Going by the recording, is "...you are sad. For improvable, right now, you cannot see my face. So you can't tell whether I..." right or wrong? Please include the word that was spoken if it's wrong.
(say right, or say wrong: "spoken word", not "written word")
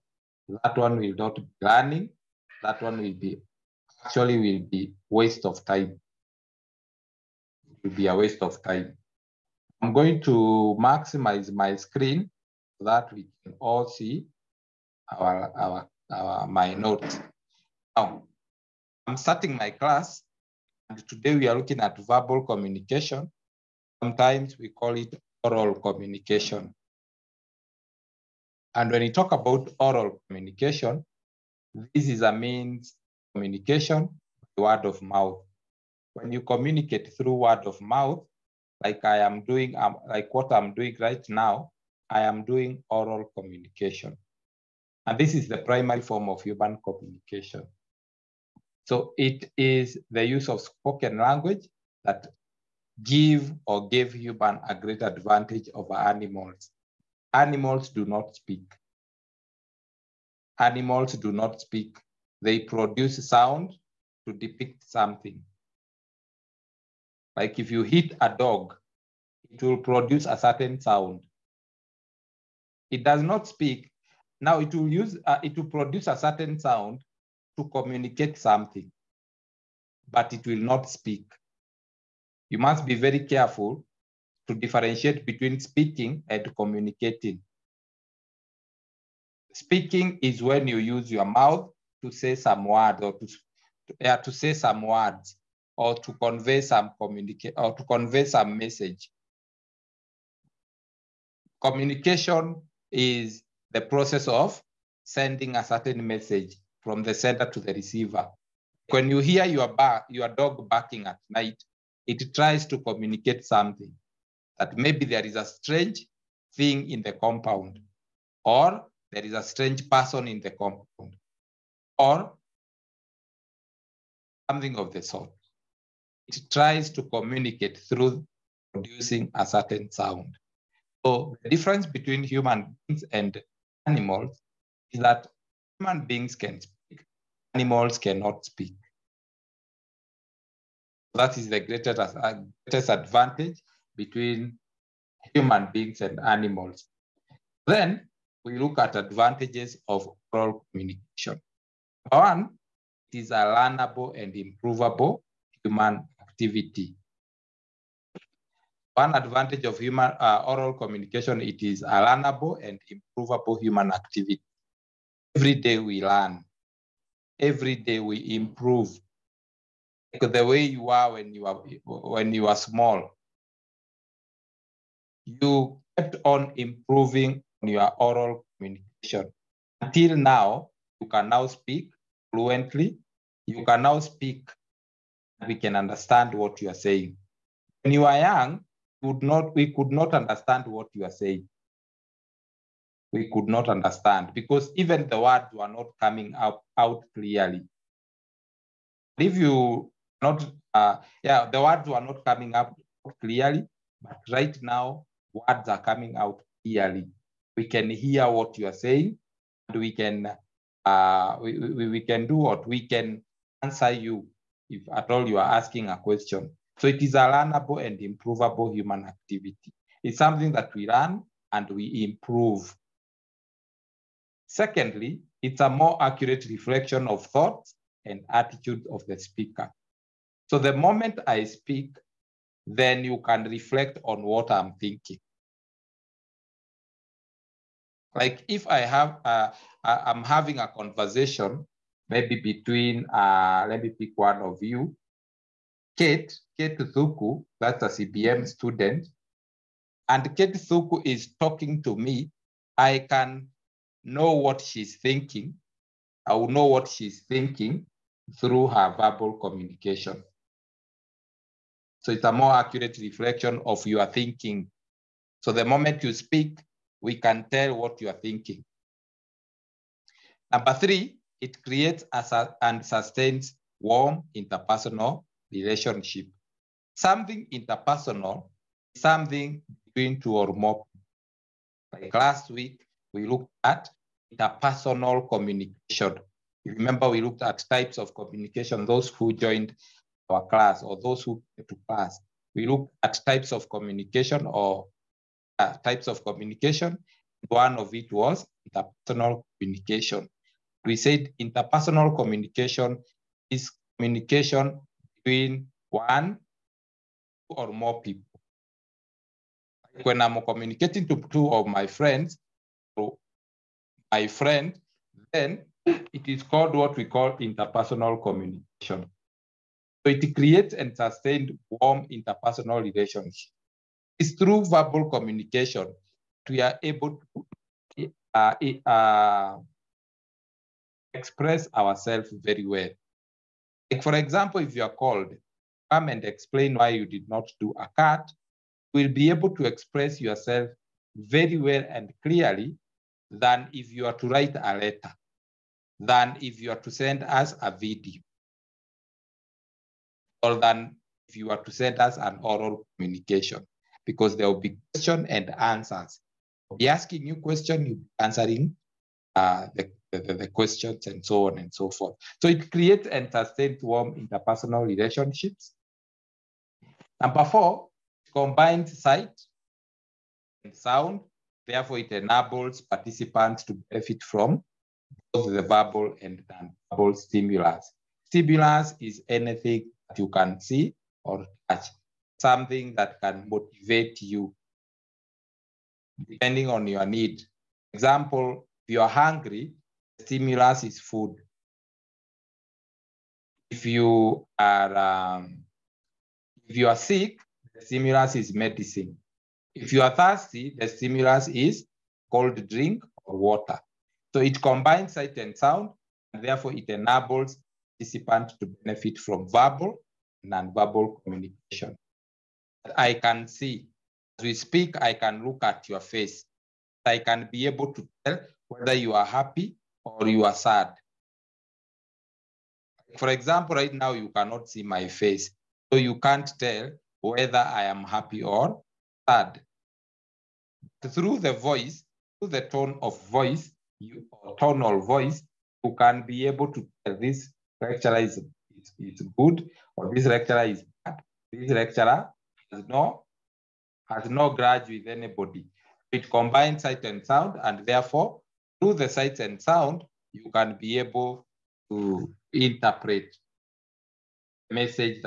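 wrong: "example", not "improvable".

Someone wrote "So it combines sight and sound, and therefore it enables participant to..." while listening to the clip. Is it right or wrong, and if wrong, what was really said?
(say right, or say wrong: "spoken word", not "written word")
right.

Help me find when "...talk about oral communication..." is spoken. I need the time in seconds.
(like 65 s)
29 s.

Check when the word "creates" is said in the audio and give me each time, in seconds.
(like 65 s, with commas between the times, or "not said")
271 s, 320 s, 362 s.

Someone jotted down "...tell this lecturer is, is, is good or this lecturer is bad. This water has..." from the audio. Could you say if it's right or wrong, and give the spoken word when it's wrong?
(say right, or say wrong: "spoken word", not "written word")
wrong: "lecturer", not "water".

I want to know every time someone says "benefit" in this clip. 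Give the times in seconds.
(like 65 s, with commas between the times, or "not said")
373 s, 408 s.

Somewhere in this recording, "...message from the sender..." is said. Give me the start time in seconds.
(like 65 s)
106 s.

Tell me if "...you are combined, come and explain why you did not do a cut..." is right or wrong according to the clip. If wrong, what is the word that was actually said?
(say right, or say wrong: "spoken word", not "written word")
wrong: "called", not "combined".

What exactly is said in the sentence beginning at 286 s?
Remember, we looked at types of communication, those who joined our class or those who came to class.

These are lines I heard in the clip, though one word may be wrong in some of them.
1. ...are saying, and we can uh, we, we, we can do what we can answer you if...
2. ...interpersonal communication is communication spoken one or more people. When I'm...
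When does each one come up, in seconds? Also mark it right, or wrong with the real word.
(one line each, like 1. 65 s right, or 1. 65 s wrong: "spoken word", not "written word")
1. 208 s right
2. 301 s wrong: "between", not "spoken".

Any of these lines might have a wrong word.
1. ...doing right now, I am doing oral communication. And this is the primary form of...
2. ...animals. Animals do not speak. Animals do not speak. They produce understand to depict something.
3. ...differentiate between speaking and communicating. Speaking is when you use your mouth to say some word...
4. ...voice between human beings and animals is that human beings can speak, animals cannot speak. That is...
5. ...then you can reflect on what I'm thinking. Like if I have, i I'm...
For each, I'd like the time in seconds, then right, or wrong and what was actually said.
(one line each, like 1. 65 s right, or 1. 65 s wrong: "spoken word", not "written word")
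1. 40 s right
2. 55 s wrong: "sound", not "understand"
3. 84 s right
4. 131 s wrong: "difference", not "voice"
5. 232 s right.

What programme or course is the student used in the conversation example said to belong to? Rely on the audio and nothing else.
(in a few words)
CBM.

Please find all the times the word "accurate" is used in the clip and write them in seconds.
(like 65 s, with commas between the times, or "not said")
226 s, 262 s.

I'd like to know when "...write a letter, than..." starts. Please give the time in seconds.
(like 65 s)
344 s.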